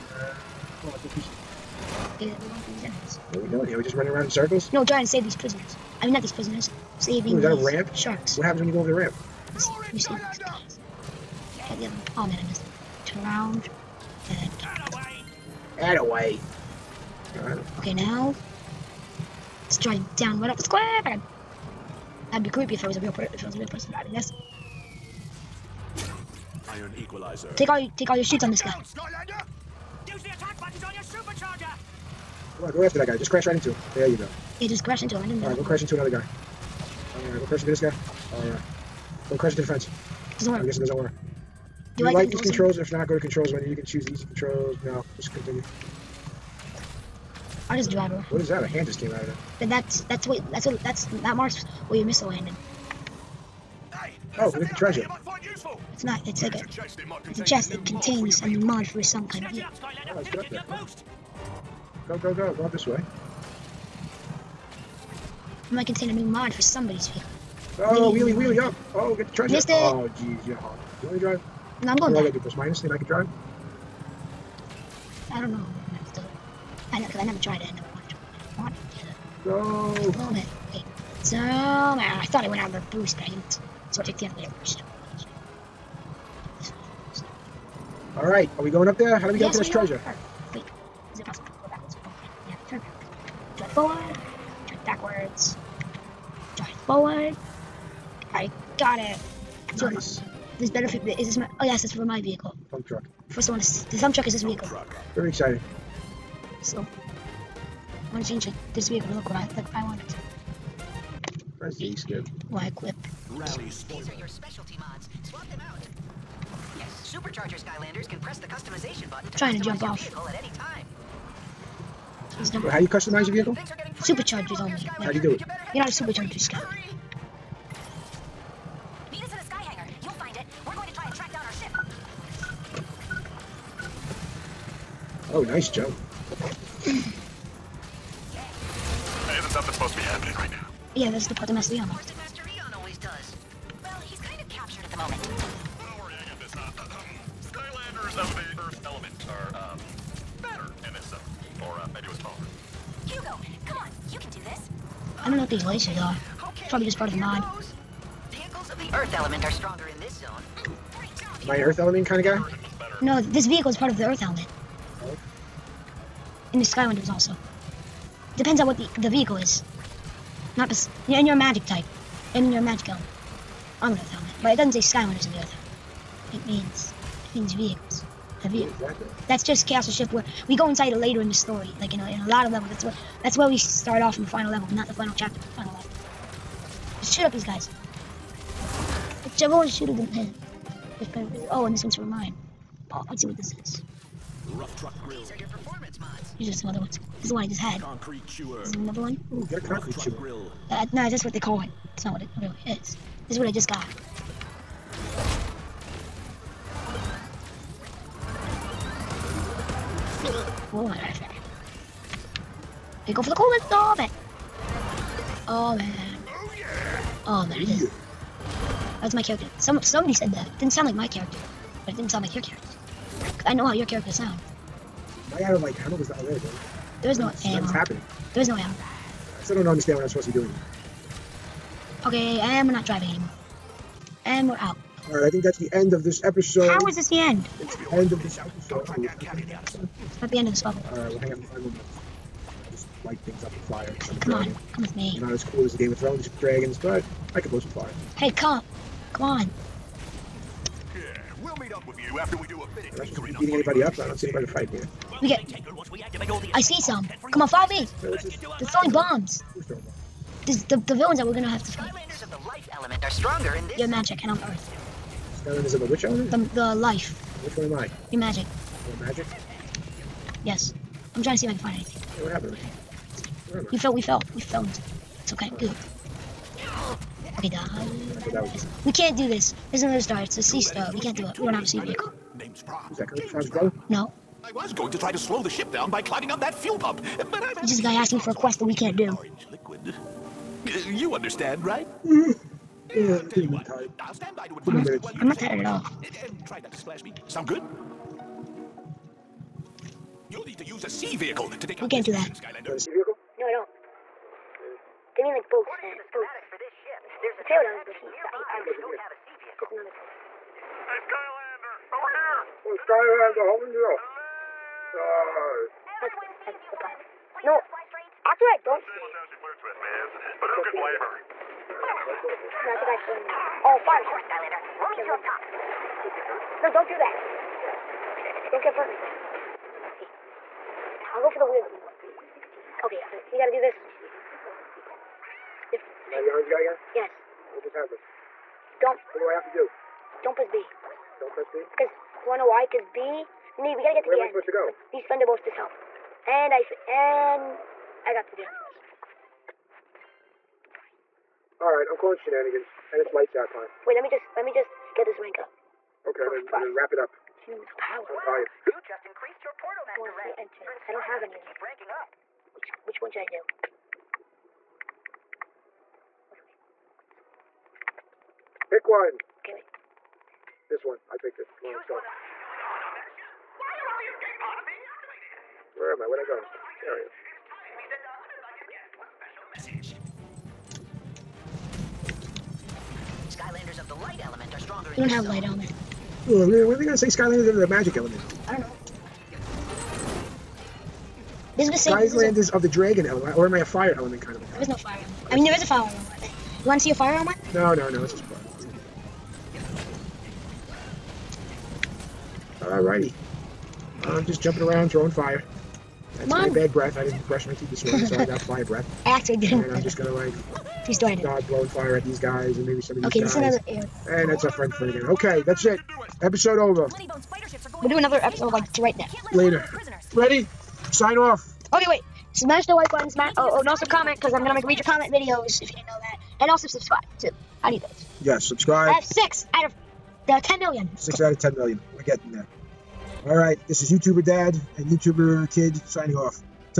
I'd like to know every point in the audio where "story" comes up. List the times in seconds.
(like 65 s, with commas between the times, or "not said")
181 s, 410 s.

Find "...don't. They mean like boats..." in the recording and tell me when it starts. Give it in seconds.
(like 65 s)
303 s.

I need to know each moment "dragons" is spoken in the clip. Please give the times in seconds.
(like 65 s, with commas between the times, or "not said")
246 s, 392 s.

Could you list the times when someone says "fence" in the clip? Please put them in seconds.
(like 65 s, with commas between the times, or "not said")
39 s.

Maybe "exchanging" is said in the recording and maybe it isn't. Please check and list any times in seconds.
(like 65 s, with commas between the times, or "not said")
not said.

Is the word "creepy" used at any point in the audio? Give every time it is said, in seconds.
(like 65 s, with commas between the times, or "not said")
22 s.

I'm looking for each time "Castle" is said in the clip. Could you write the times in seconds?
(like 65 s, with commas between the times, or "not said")
179 s.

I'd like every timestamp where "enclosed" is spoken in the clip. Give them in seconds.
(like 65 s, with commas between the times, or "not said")
not said.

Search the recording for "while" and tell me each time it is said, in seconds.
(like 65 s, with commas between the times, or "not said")
295 s.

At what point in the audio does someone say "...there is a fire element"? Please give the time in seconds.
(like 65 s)
395 s.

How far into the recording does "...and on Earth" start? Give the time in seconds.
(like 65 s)
264 s.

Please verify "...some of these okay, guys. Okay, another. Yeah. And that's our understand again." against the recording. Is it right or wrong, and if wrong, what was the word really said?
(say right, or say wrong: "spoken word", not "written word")
wrong: "friend", not "understand".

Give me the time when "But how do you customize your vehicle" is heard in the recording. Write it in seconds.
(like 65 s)
122 s.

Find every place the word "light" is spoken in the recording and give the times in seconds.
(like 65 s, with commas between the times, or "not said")
243 s, 353 s.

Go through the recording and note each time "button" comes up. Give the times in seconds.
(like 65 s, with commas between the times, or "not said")
30 s, 119 s, 422 s.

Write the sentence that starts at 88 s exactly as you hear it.
Alright, are we going up there?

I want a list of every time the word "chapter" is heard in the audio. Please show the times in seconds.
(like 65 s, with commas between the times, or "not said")
185 s.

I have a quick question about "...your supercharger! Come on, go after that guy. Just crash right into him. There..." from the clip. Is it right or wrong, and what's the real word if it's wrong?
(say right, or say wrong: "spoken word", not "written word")
right.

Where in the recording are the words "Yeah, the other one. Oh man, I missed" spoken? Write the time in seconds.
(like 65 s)
10 s.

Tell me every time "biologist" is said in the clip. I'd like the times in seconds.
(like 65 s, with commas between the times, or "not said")
not said.